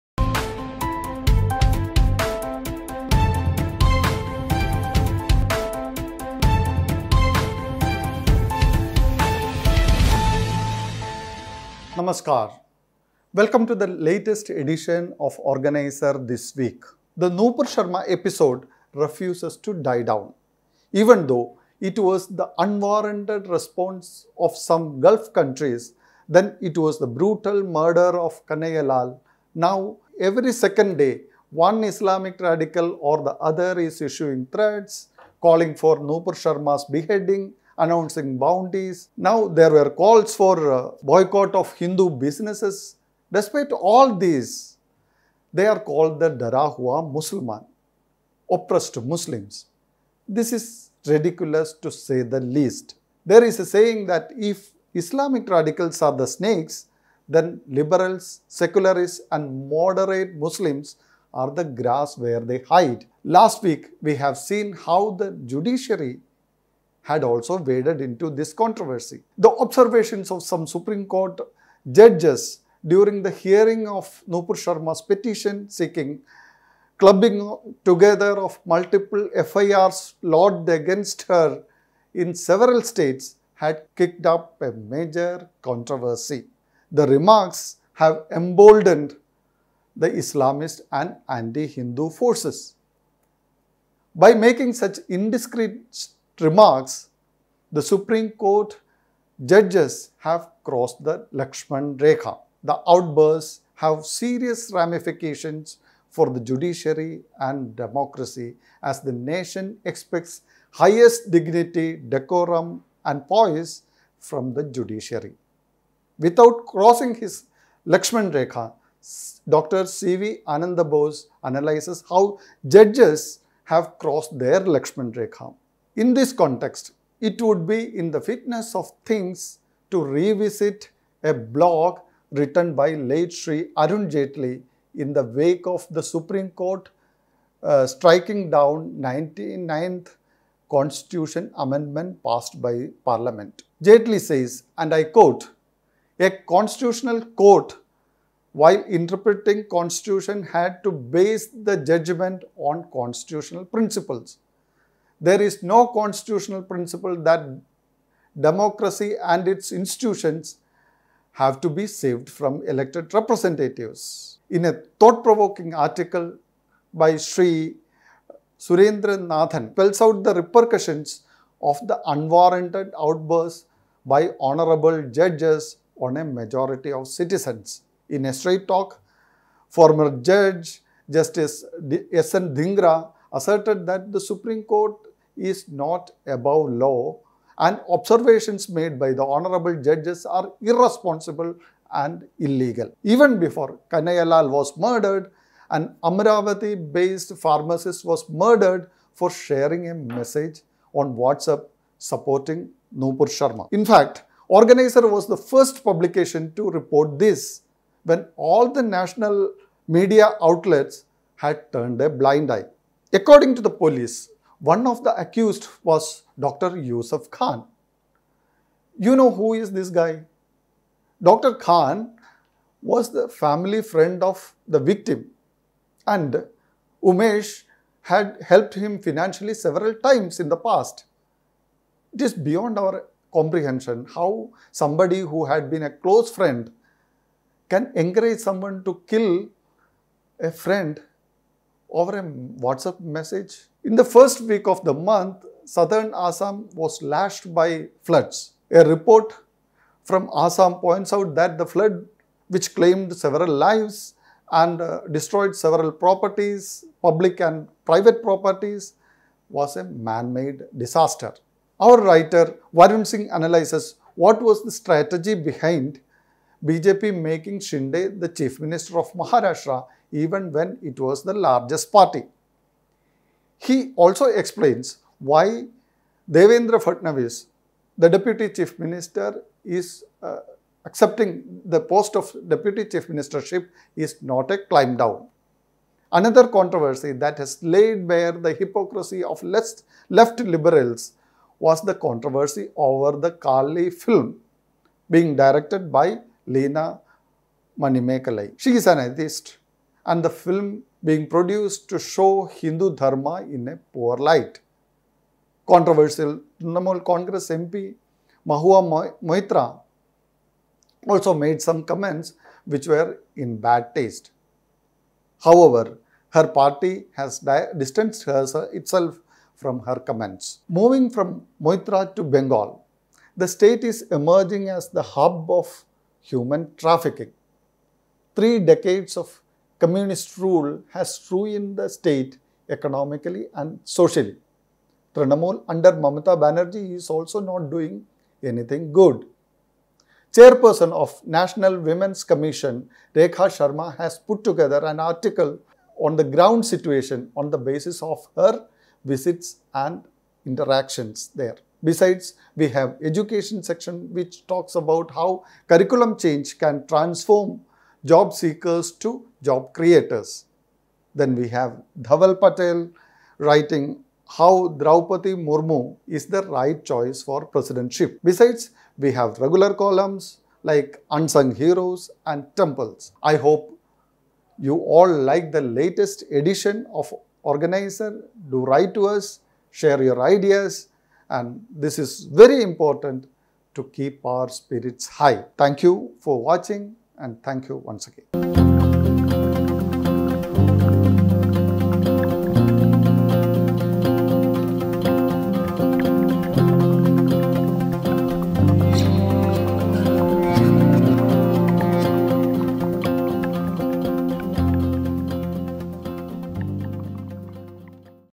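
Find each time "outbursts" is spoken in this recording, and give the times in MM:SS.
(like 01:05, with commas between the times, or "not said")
01:42, 02:52.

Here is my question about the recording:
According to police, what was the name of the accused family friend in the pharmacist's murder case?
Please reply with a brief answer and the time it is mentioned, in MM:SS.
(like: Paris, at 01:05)
Dr. Yusuf Khan, at 03:36.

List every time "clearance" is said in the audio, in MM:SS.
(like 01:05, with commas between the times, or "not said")
not said.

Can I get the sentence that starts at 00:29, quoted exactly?
Now, every second day, one Islamic radical or the other is issuing threats, calling for Nupur Sharma's beheading, announcing bounties.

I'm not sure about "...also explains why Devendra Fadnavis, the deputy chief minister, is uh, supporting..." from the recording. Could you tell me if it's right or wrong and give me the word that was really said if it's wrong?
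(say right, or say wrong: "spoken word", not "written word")
wrong: "accepting", not "supporting".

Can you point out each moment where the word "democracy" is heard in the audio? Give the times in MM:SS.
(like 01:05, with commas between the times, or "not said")
01:47, 02:38.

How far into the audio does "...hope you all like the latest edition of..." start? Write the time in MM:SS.
06:13.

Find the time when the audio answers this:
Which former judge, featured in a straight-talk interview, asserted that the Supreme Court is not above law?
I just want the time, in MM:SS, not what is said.
03:01.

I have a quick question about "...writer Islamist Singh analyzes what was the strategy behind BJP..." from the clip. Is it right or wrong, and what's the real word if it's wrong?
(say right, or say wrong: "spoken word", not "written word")
wrong: "Varun", not "Islamist".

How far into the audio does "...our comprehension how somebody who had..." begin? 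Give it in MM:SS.
03:52.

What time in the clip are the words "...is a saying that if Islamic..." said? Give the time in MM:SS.
00:53.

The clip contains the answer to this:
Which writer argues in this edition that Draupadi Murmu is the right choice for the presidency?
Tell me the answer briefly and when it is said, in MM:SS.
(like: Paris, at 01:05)
Dhaval Patel, at 06:02.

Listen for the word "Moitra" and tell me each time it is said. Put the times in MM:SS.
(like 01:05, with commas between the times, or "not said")
05:09, 05:21.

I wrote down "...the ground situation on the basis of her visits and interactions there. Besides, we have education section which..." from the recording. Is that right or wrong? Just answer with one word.
right.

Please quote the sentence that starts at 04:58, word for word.
She is an atheist and the film being produced to show Hindu Dharma in a poor light.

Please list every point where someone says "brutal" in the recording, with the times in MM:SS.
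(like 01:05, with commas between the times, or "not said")
00:27.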